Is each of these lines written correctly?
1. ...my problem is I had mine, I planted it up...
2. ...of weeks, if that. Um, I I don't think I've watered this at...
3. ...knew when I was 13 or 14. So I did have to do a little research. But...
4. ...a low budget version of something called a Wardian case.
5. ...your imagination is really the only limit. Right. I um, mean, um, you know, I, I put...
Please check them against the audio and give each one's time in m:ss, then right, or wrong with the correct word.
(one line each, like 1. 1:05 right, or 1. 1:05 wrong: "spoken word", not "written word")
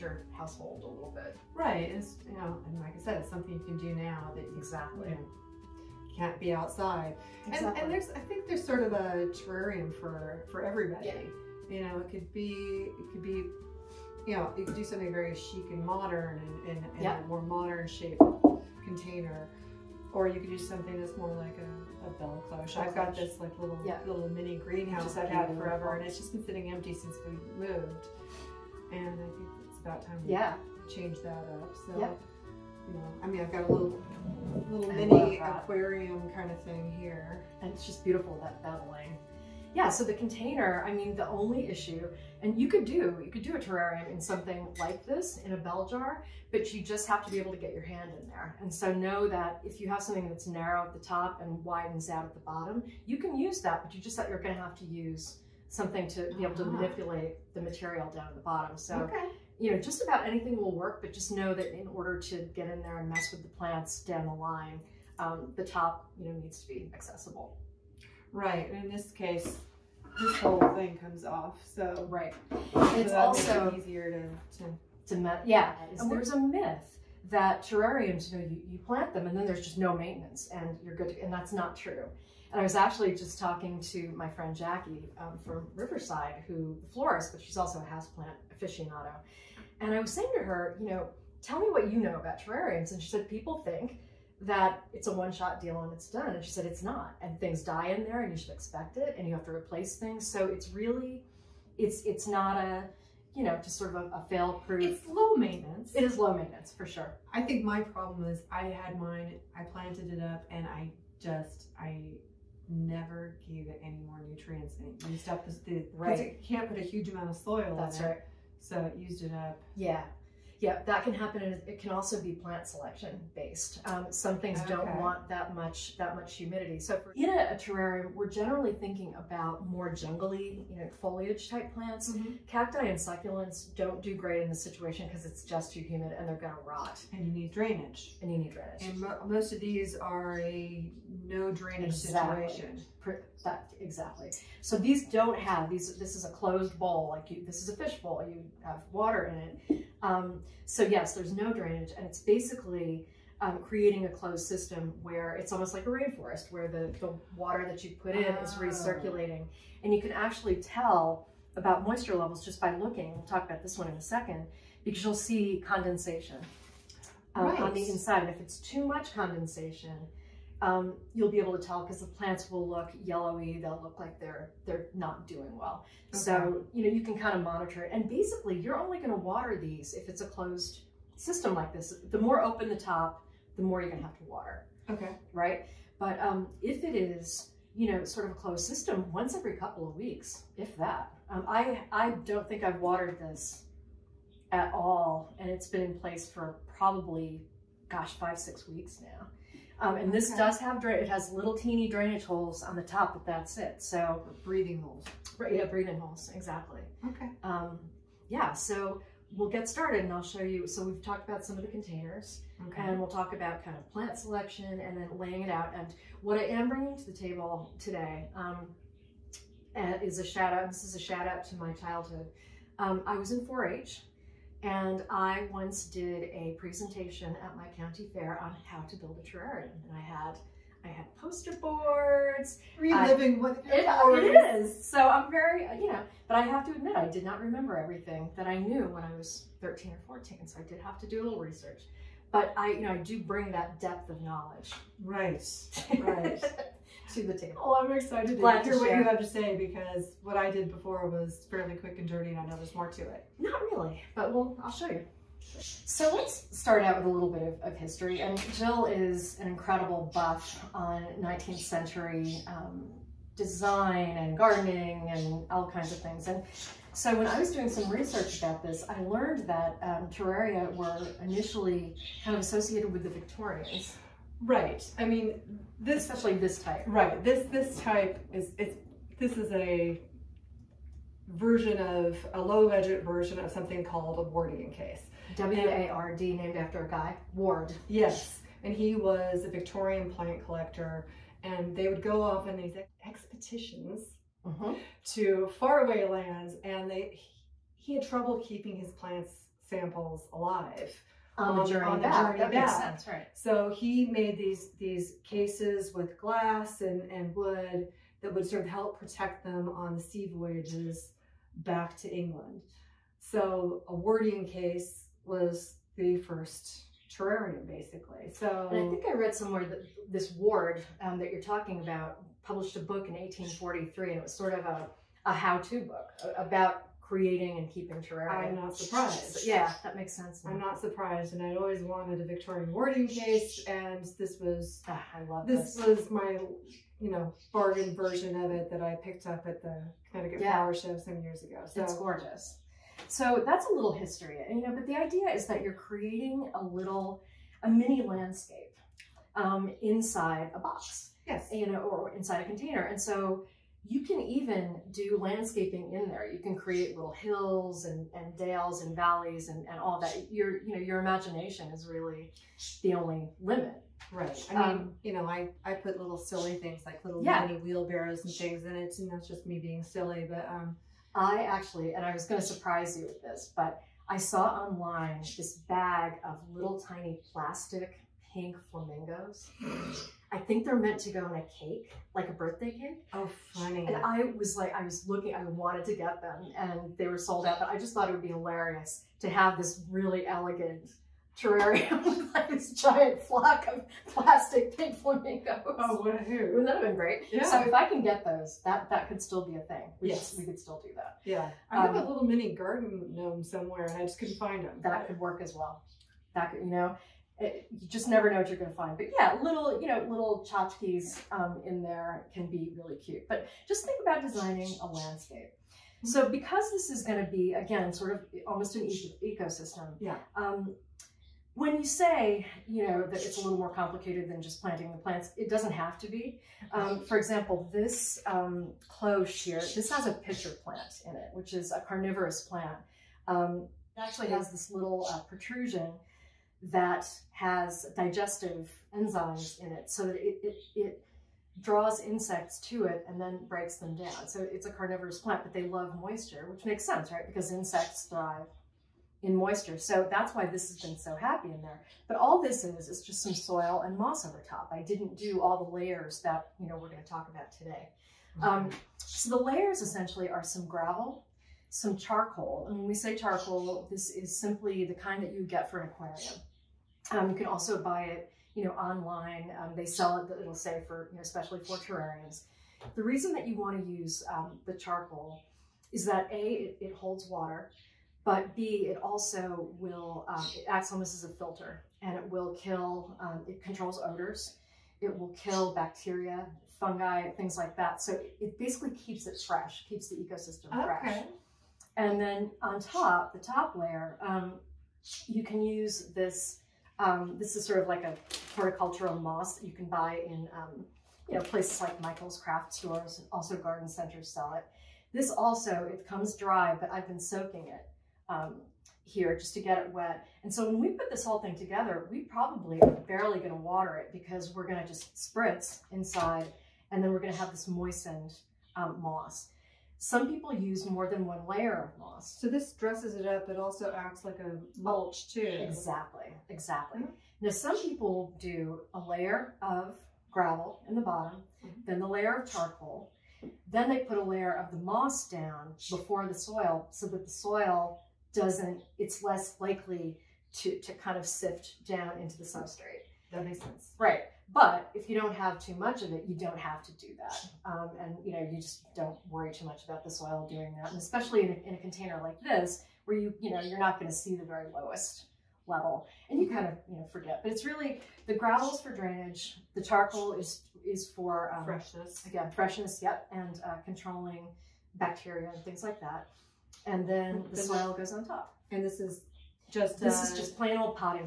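1. 1:47 right
2. 3:09 right
3. 3:58 right
4. 4:42 right
5. 6:00 right.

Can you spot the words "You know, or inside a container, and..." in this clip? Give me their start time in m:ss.
5:51.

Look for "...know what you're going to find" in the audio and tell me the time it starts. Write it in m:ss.
6:48.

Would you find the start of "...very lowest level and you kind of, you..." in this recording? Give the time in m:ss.
9:14.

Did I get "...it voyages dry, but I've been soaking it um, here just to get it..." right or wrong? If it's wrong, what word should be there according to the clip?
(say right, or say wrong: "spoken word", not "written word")
wrong: "comes", not "voyages".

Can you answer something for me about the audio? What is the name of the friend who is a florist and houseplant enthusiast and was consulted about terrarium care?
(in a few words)
Jackie.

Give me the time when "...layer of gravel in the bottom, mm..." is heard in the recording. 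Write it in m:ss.
8:49.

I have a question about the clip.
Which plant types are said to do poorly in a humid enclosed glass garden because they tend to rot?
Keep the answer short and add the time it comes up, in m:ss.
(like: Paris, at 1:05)
Cacti and succulents, at 2:12.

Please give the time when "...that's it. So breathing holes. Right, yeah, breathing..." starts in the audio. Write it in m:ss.
3:23.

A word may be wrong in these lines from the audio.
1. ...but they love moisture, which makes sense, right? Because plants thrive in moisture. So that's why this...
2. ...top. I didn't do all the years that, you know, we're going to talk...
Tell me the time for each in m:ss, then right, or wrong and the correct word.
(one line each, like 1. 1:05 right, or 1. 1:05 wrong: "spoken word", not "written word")
1. 7:25 wrong: "insects", not "plants"
2. 7:34 wrong: "layers", not "years".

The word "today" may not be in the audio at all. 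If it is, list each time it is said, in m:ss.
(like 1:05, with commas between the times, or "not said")
3:37, 7:37.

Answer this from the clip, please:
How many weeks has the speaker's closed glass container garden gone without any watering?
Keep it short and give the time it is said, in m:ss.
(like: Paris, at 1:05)
5 or 6 weeks, at 3:18.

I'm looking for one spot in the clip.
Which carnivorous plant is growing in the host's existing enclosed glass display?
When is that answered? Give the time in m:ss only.
7:10.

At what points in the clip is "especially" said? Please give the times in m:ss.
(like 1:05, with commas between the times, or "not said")
4:36, 7:51, 9:10.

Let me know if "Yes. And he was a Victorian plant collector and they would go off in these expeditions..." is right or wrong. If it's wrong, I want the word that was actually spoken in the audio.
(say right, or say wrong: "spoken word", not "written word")
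right.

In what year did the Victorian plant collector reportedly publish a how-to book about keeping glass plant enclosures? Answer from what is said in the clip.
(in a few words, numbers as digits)
1843.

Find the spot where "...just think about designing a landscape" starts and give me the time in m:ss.
6:53.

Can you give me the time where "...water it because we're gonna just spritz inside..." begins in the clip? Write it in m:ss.
8:33.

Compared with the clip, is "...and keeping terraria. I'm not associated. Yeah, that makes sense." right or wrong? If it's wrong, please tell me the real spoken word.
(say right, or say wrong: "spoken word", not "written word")
wrong: "surprised", not "associated".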